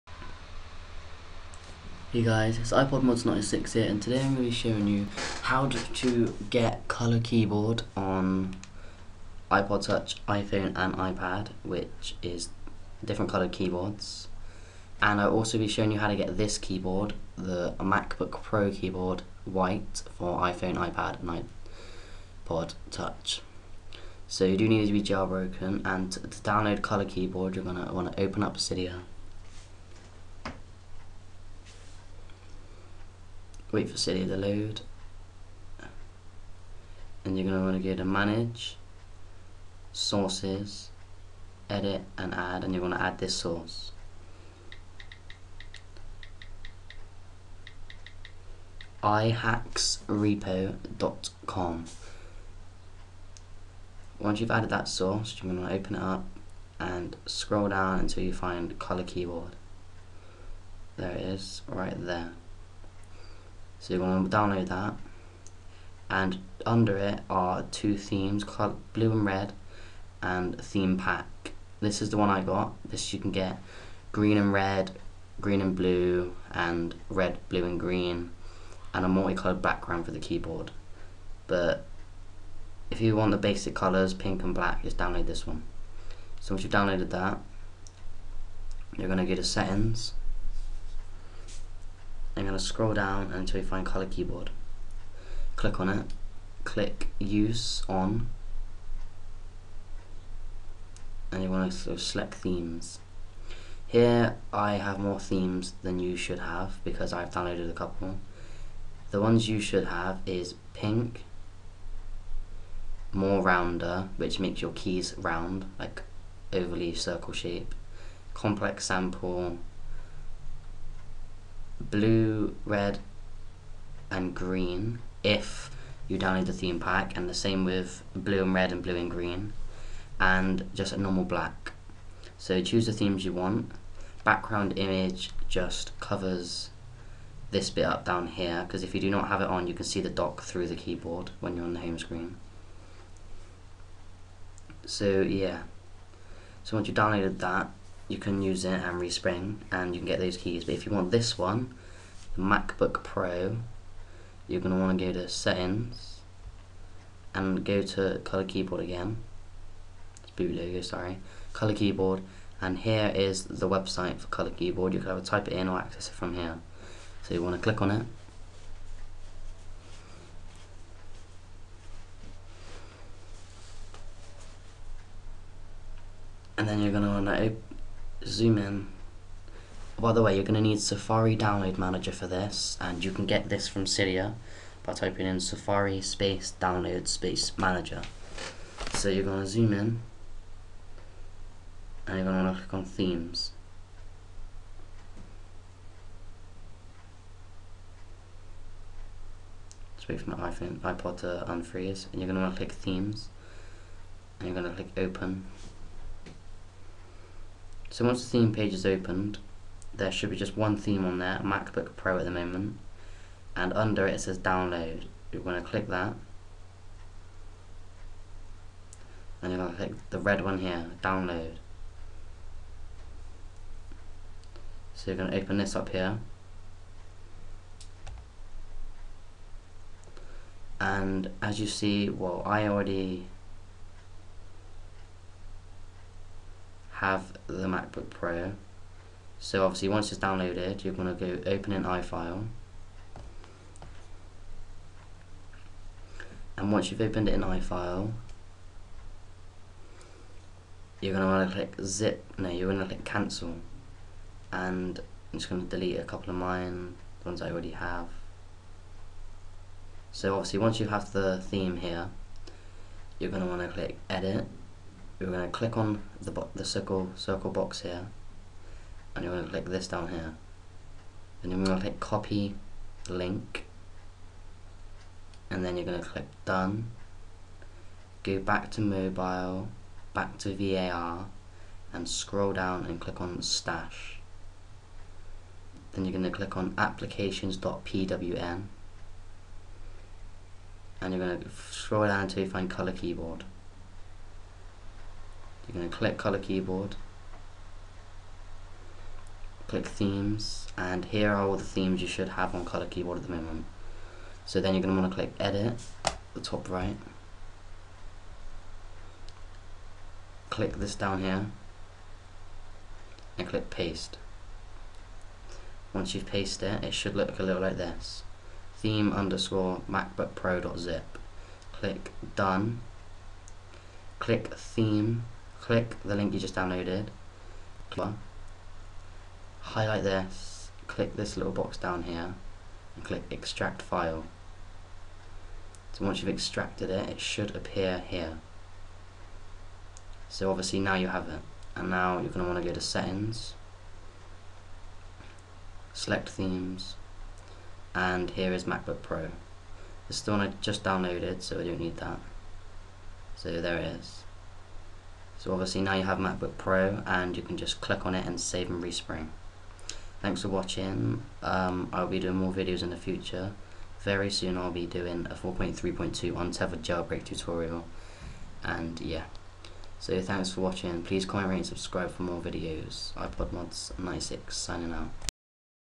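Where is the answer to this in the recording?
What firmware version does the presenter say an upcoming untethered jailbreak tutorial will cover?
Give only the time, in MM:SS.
06:05.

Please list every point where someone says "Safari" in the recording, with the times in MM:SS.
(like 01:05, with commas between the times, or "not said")
03:00, 03:05.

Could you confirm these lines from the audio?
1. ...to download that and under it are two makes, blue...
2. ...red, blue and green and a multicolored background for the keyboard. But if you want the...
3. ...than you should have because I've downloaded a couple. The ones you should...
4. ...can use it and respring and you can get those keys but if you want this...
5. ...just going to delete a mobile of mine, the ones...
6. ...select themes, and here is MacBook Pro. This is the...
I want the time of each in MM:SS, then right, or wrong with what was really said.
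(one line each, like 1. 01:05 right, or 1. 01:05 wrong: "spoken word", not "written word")
1. 01:04 wrong: "themes", not "makes"
2. 01:17 right
3. 01:45 right
4. 02:28 right
5. 04:15 wrong: "couple", not "mobile"
6. 05:45 right.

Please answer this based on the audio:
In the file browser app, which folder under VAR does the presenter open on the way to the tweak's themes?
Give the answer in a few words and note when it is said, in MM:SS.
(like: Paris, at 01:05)
stash, at 04:43.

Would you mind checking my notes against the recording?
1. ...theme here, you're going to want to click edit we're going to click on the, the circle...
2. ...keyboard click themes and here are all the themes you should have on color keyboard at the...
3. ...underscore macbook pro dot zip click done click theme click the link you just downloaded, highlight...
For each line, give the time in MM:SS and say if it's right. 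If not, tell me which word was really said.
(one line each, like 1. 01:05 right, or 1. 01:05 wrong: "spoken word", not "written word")
1. 04:21 right
2. 04:56 right
3. 05:19 right.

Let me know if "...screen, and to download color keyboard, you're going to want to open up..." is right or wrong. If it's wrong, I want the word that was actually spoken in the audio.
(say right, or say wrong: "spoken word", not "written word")
wrong: "jailbroken", not "screen".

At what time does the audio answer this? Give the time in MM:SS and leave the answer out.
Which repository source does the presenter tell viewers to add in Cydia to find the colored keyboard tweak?
00:49.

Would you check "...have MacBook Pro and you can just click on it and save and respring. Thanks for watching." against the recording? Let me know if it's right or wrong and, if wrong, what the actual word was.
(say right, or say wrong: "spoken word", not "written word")
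right.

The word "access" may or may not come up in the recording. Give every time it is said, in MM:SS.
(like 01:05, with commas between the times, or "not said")
02:45.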